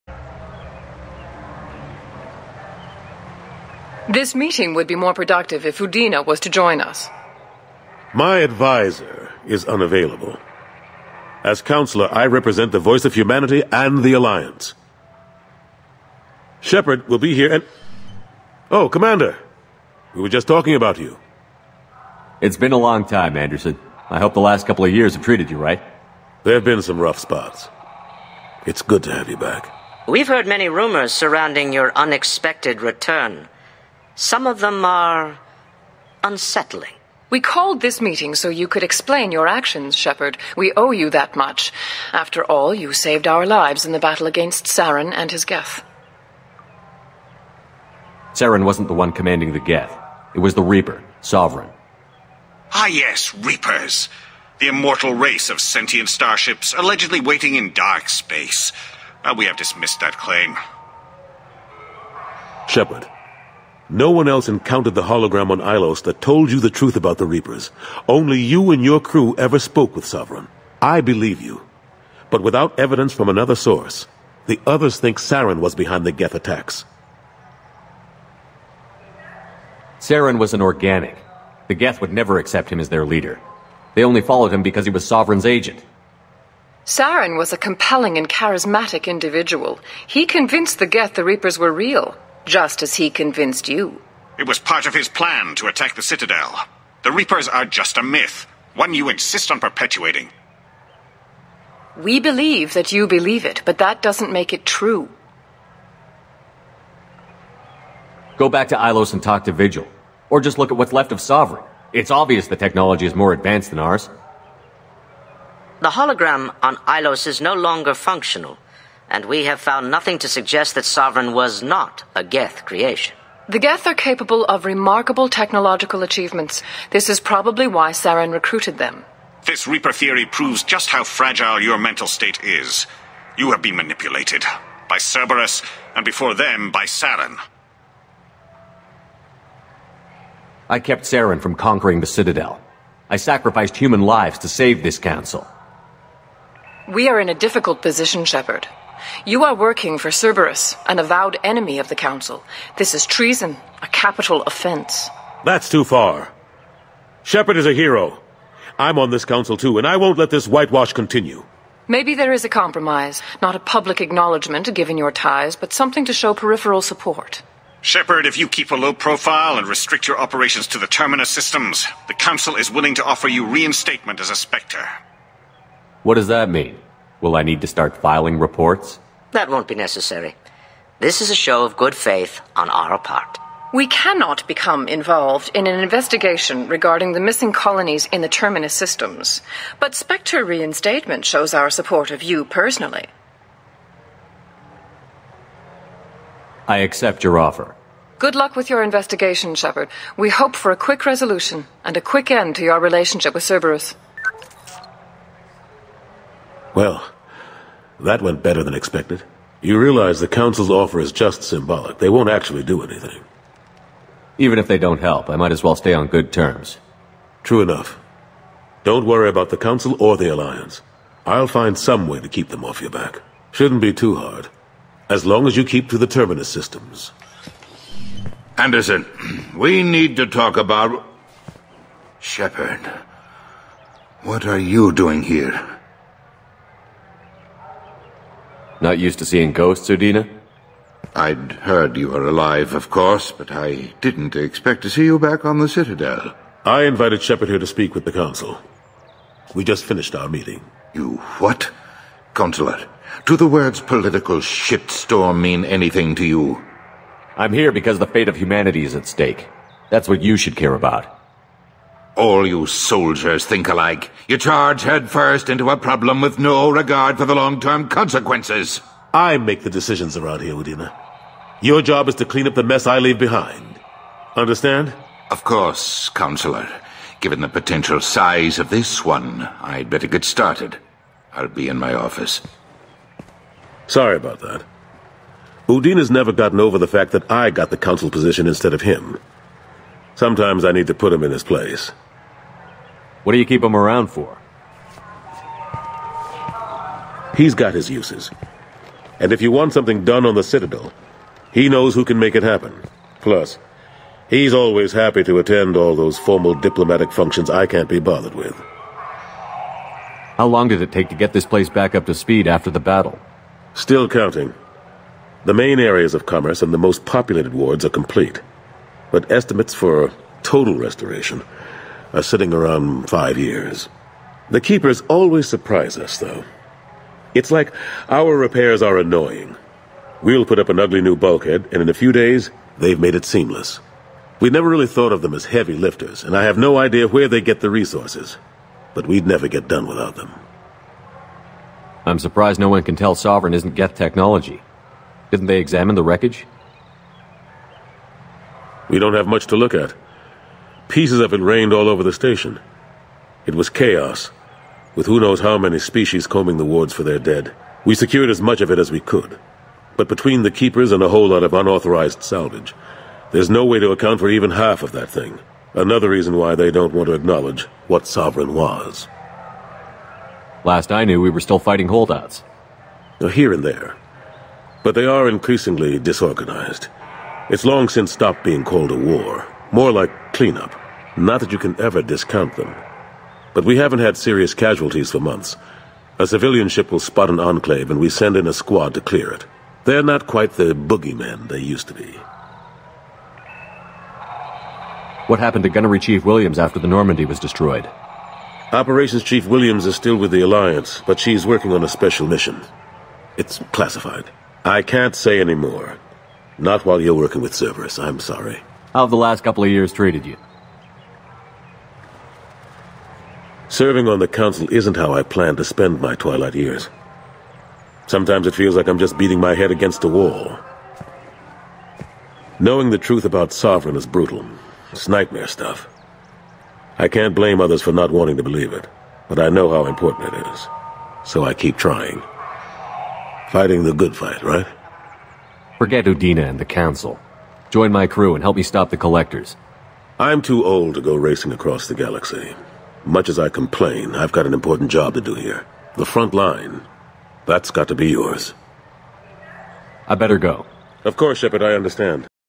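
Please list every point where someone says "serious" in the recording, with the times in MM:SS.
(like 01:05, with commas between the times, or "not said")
06:24.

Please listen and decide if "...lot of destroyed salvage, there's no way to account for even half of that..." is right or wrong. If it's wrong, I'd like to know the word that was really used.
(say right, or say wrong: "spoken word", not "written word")
wrong: "unauthorized", not "destroyed".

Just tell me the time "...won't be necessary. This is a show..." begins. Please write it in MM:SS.
02:59.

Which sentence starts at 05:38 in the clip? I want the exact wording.
But we'd never get done without them.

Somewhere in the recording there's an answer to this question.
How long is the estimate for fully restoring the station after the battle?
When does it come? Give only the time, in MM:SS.
05:23.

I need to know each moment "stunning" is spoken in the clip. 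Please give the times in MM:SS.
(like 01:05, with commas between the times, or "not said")
not said.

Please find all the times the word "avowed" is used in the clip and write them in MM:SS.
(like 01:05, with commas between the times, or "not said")
02:30.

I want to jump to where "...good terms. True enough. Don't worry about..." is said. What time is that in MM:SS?
03:36.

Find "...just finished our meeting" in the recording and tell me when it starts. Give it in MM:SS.
04:09.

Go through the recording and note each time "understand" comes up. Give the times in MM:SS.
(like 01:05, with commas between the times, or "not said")
04:34, 07:31.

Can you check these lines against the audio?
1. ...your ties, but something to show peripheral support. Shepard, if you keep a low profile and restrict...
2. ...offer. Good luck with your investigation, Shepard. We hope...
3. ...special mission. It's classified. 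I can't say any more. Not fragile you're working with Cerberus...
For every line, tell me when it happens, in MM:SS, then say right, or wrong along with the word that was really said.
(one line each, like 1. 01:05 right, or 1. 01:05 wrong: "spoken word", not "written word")
1. 02:44 right
2. 03:17 right
3. 06:41 wrong: "while", not "fragile".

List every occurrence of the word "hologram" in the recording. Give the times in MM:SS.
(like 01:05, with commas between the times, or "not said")
01:05, 01:55.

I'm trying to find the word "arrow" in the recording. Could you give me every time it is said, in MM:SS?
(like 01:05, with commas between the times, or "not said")
not said.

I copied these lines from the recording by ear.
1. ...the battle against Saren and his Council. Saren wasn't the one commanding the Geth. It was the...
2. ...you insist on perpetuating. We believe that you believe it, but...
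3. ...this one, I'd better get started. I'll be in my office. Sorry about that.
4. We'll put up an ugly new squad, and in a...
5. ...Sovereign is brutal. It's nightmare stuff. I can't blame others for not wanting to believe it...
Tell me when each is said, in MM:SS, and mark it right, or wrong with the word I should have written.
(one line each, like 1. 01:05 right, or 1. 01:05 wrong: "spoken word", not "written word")
1. 00:43 wrong: "Geth", not "Council"
2. 01:38 right
3. 04:38 right
4. 05:30 wrong: "bulkhead", not "squad"
5. 07:03 right.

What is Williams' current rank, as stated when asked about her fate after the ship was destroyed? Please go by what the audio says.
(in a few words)
Operations Chief.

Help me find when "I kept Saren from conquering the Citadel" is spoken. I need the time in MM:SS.
02:20.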